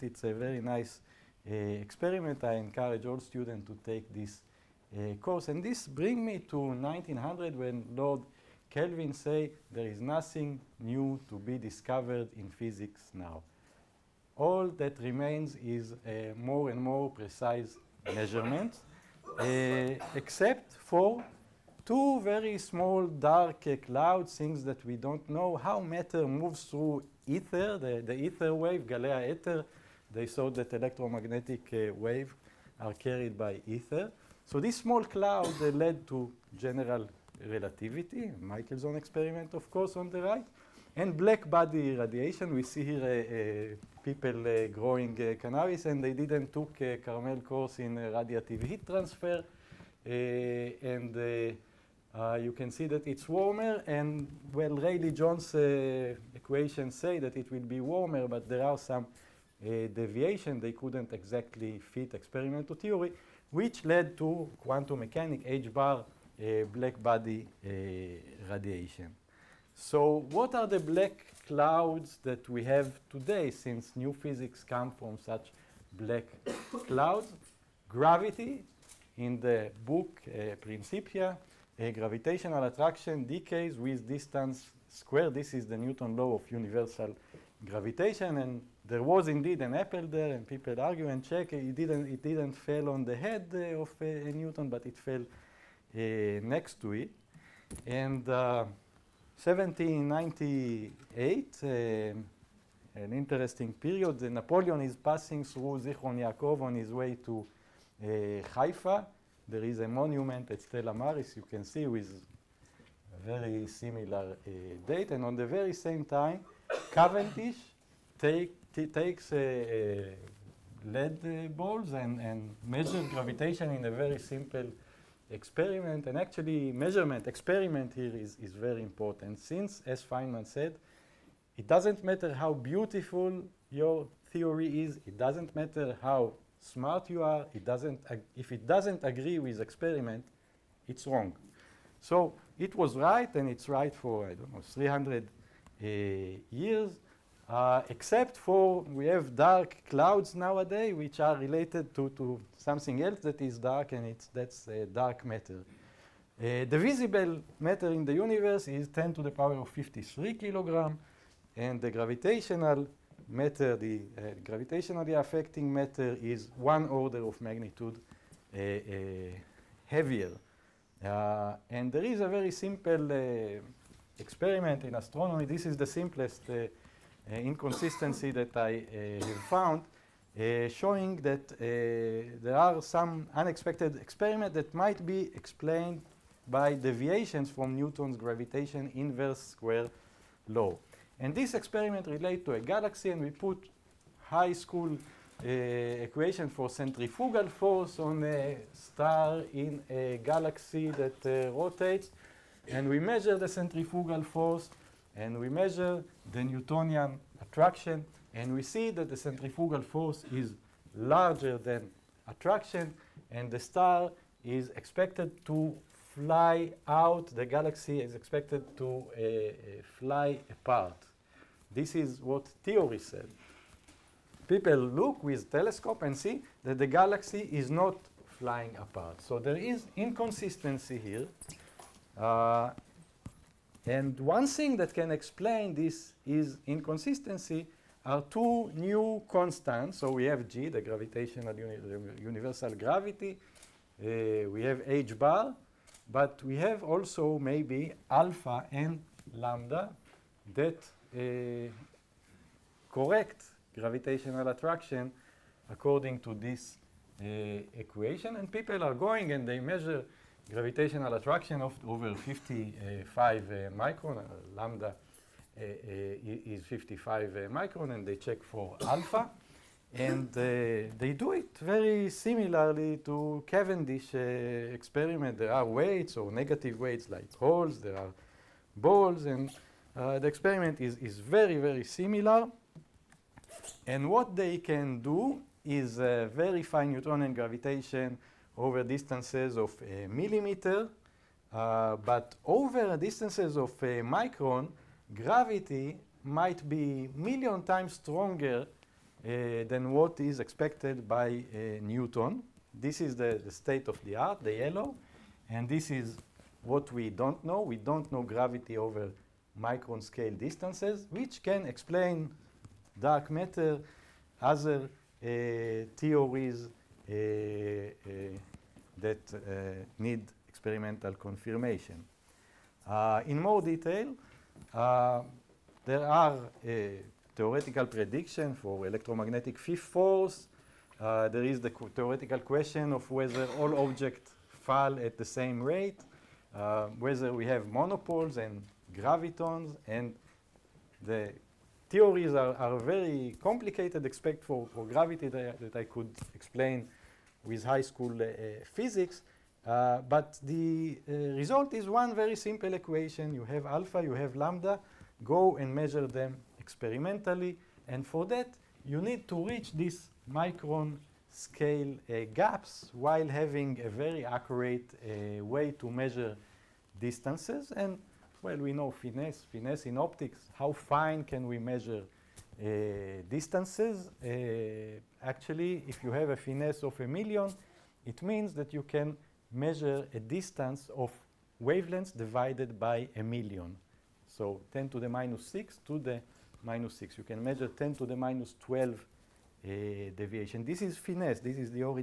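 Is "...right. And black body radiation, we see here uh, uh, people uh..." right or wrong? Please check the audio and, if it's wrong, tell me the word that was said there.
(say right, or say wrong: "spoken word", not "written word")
right.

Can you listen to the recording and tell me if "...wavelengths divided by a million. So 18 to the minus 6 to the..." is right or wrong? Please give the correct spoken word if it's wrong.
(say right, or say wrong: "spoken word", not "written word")
wrong: "10", not "18".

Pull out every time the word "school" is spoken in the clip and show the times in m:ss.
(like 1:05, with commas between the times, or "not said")
3:14, 5:47.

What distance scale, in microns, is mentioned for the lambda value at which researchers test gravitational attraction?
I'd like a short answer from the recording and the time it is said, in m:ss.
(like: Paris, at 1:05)
55 microns, at 4:26.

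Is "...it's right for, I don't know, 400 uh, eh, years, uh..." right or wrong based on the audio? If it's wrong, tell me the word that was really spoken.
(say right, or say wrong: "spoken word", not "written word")
wrong: "300", not "400".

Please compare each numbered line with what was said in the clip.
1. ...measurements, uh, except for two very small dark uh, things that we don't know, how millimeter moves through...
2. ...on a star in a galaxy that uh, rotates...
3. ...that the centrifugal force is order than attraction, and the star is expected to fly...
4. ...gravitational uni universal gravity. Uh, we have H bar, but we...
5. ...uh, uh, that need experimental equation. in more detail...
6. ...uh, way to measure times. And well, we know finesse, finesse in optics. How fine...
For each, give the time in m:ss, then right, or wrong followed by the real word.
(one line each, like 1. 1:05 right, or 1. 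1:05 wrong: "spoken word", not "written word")
1. 0:18 wrong: "matter", not "millimeter"
2. 3:17 right
3. 3:28 wrong: "larger", not "order"
4. 4:00 right
5. 5:16 wrong: "confirmation", not "equation"
6. 6:05 wrong: "distances", not "times".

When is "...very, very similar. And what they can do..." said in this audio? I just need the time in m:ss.
4:41.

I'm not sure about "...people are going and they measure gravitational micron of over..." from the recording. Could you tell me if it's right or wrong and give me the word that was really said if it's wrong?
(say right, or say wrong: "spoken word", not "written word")
wrong: "attraction", not "micron".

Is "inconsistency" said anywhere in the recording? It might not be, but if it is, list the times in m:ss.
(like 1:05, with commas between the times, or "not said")
2:57, 3:49, 3:56.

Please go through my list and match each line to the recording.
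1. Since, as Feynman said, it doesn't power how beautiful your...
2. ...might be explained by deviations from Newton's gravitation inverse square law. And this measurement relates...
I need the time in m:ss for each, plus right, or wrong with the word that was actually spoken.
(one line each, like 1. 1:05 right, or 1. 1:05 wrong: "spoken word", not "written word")
1. 2:09 wrong: "matter", not "power"
2. 3:04 wrong: "experiment", not "measurement".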